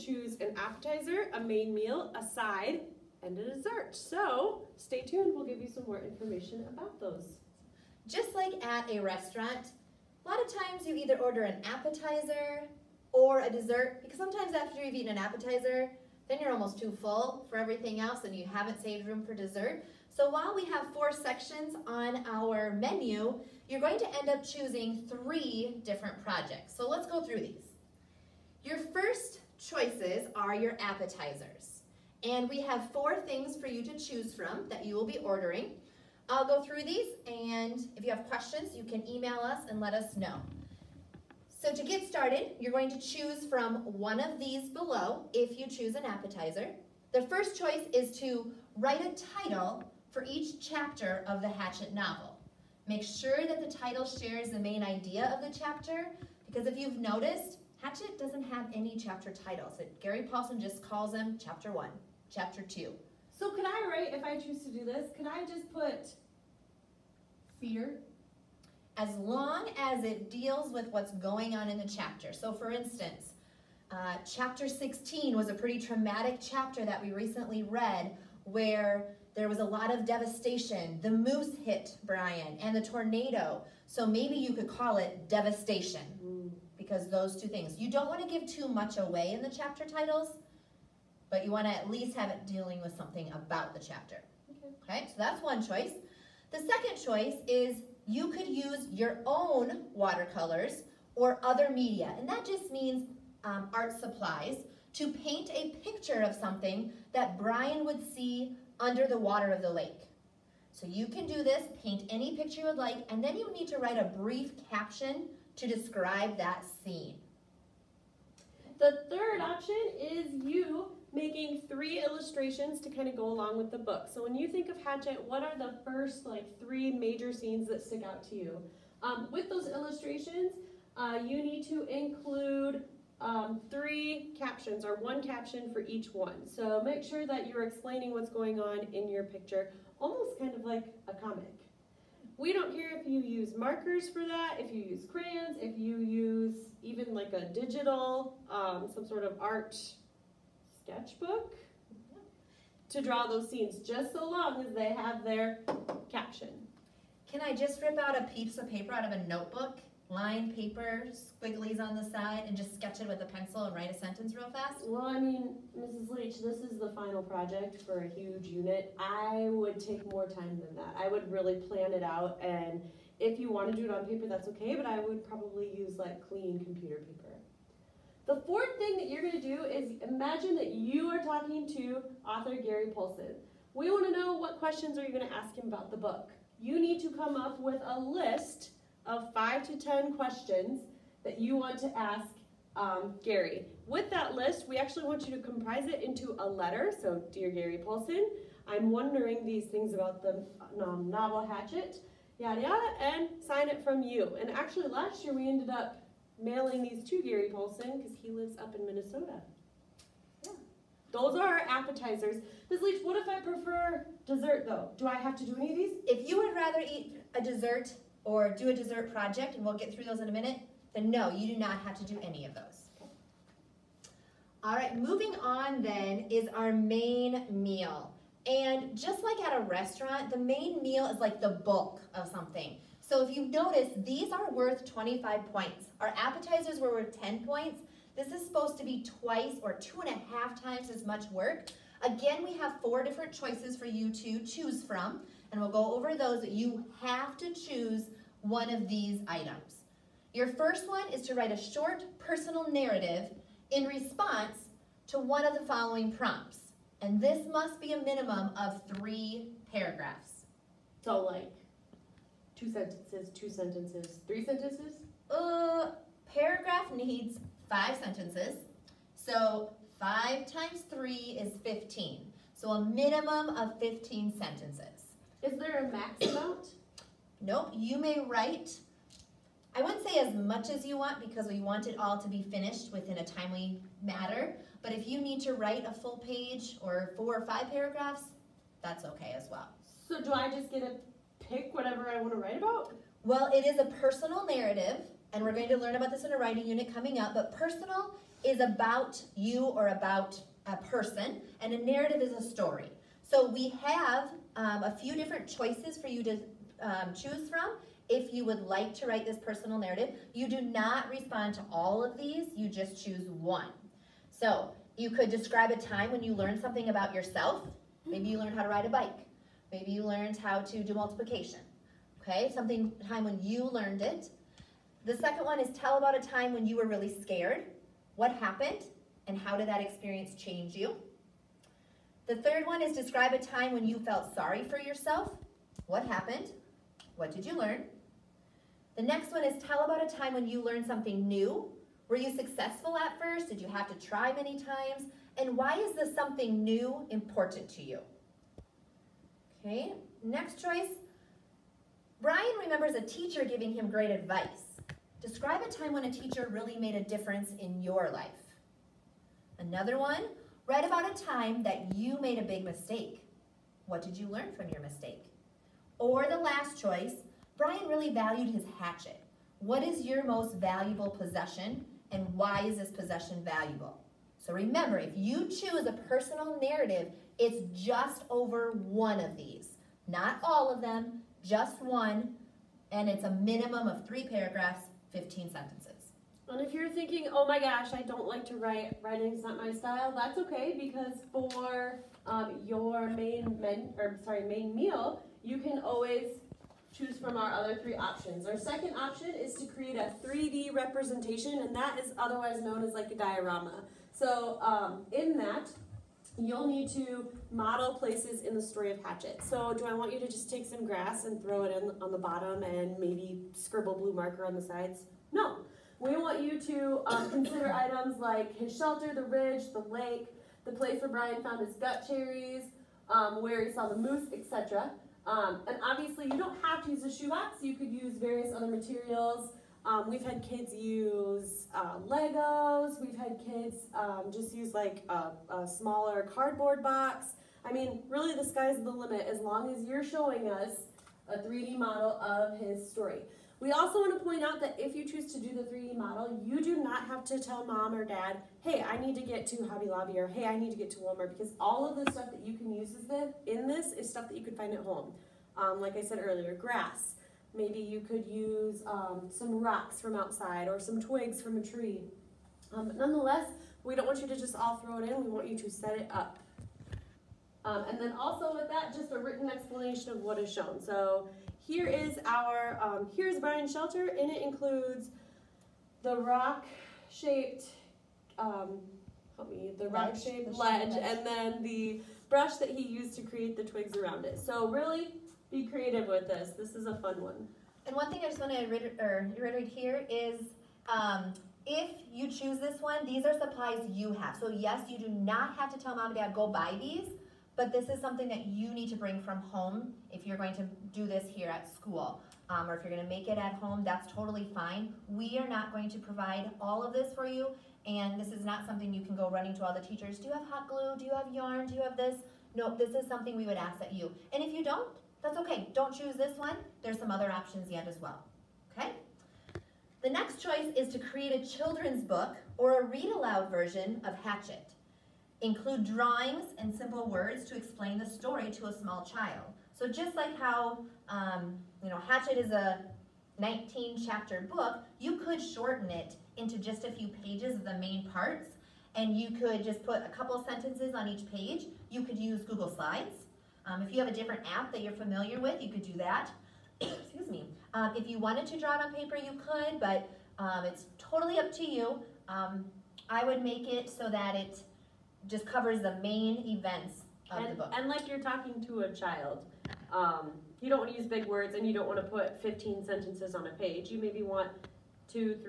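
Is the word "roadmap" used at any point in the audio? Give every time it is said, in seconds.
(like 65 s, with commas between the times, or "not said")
not said.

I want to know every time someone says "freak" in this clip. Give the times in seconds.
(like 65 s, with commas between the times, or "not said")
not said.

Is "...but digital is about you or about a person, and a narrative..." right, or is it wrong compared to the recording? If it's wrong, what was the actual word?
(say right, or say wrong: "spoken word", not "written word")
wrong: "personal", not "digital".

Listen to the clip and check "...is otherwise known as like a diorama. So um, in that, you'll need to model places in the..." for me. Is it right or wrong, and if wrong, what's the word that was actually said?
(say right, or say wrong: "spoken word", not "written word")
right.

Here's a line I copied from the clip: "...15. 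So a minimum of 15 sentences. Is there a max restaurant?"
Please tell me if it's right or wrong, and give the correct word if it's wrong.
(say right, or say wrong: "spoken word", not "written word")
wrong: "amount", not "restaurant".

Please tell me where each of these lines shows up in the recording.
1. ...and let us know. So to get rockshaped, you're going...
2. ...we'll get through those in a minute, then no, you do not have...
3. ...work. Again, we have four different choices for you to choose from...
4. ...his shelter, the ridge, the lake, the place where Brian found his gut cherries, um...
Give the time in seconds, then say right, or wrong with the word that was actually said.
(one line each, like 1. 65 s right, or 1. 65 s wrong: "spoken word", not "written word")
1. 39 s wrong: "started", not "rockshaped"
2. 219 s right
3. 241 s right
4. 418 s right.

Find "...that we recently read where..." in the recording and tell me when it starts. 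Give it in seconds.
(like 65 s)
76 s.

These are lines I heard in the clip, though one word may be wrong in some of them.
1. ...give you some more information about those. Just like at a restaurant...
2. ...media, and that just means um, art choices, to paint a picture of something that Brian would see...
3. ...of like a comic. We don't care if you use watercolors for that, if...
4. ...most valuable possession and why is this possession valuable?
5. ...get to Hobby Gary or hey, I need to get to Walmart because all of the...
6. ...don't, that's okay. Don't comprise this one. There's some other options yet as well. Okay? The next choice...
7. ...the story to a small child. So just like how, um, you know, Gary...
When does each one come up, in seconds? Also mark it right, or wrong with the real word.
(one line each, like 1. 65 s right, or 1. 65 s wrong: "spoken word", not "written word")
1. 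5 s right
2. 101 s wrong: "supplies", not "choices"
3. 140 s wrong: "markers", not "watercolors"
4. 370 s right
5. 449 s wrong: "Lobby", not "Gary"
6. 514 s wrong: "choose", not "comprise"
7. 527 s wrong: "Hatchet", not "Gary".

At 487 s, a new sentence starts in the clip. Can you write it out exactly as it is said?
And one thing I just want to reiterate here is um, if you choose this one, these are supplies you have.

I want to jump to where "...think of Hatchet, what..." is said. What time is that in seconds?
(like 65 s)
124 s.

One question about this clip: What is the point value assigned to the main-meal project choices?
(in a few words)
25.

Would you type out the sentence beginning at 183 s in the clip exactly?
We want to know what questions are you going to ask him about the book.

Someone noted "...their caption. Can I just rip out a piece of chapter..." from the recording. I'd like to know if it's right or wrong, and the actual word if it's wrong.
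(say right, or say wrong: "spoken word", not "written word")
wrong: "paper", not "chapter".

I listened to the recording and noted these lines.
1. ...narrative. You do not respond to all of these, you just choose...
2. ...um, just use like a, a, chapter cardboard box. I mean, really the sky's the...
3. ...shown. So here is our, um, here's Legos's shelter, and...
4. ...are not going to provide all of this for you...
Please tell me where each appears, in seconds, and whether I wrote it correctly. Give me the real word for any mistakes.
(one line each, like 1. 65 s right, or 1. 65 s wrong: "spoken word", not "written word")
1. 309 s right
2. 433 s wrong: "smaller", not "chapter"
3. 470 s wrong: "Brian", not "Legos"
4. 505 s right.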